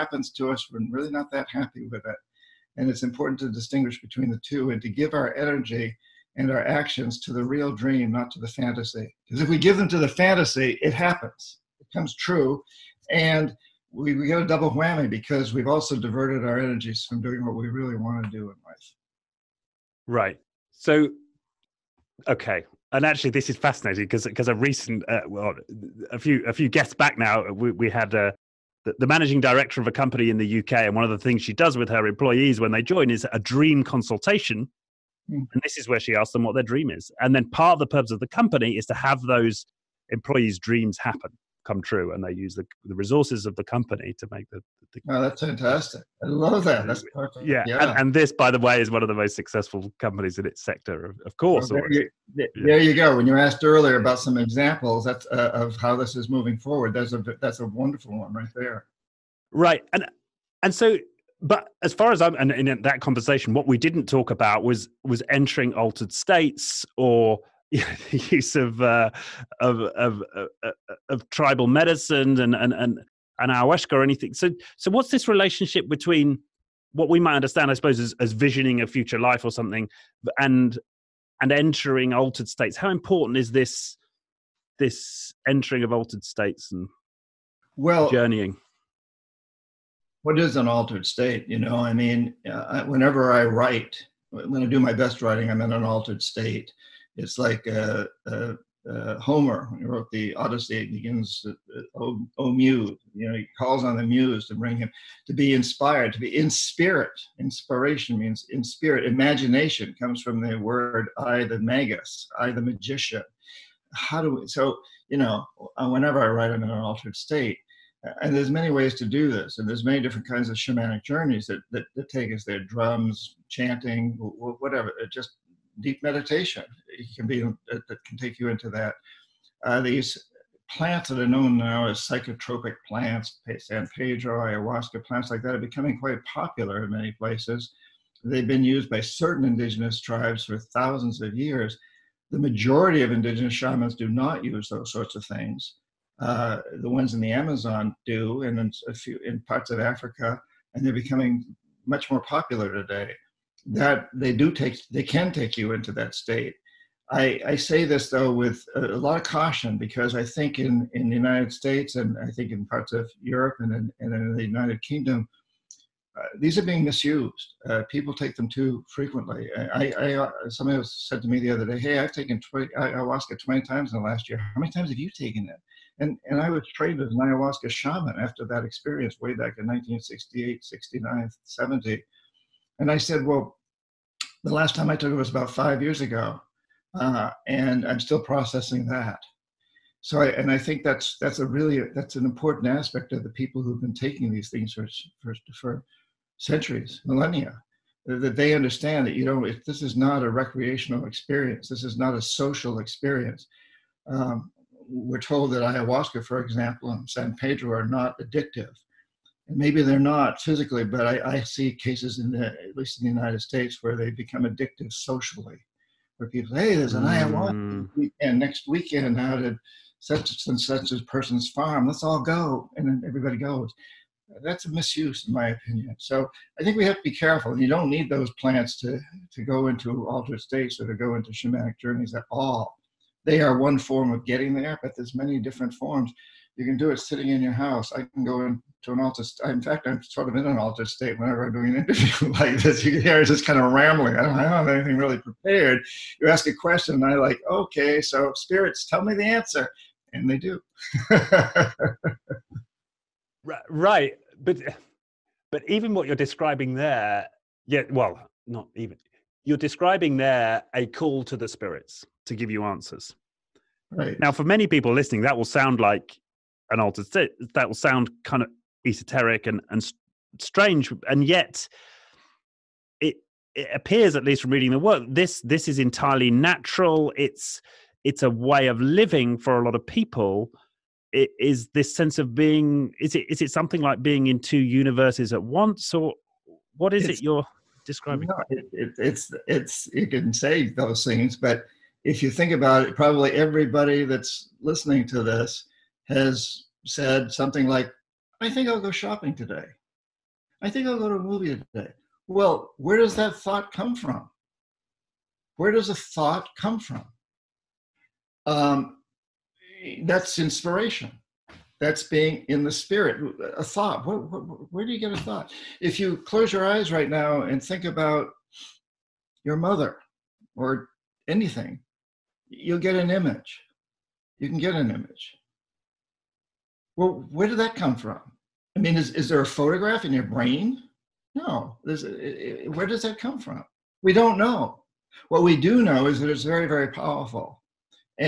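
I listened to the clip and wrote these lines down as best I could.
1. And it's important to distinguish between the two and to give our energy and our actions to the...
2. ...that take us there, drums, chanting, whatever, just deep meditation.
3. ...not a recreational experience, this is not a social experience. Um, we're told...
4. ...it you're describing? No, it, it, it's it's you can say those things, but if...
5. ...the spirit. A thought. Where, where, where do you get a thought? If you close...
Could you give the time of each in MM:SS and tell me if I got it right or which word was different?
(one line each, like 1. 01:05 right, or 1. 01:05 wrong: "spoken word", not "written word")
1. 00:02 right
2. 02:01 right
3. 03:19 right
4. 04:47 right
5. 05:12 right.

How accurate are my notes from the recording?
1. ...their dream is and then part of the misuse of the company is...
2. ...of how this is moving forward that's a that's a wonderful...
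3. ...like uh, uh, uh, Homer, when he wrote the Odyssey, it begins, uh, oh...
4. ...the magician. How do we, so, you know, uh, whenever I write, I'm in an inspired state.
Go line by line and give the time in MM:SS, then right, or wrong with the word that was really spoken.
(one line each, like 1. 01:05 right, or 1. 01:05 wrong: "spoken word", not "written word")
1. 00:36 wrong: "purpose", not "misuse"
2. 00:55 right
3. 01:37 right
4. 01:52 wrong: "altered", not "inspired".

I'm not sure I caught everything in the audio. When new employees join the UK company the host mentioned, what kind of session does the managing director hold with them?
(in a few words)
Dream consultation.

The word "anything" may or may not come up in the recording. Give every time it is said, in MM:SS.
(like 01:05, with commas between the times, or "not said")
01:14, 04:04, 05:21.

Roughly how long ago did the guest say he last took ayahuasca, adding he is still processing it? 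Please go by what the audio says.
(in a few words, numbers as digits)
About 5 years ago.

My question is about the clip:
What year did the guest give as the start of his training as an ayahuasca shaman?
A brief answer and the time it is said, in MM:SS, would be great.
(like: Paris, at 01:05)
1968, at 02:59.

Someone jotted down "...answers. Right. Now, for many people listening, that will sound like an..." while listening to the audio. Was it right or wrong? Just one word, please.
right.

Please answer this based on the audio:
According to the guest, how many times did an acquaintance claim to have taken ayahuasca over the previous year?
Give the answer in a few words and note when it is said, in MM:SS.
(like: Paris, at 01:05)
20, at 02:53.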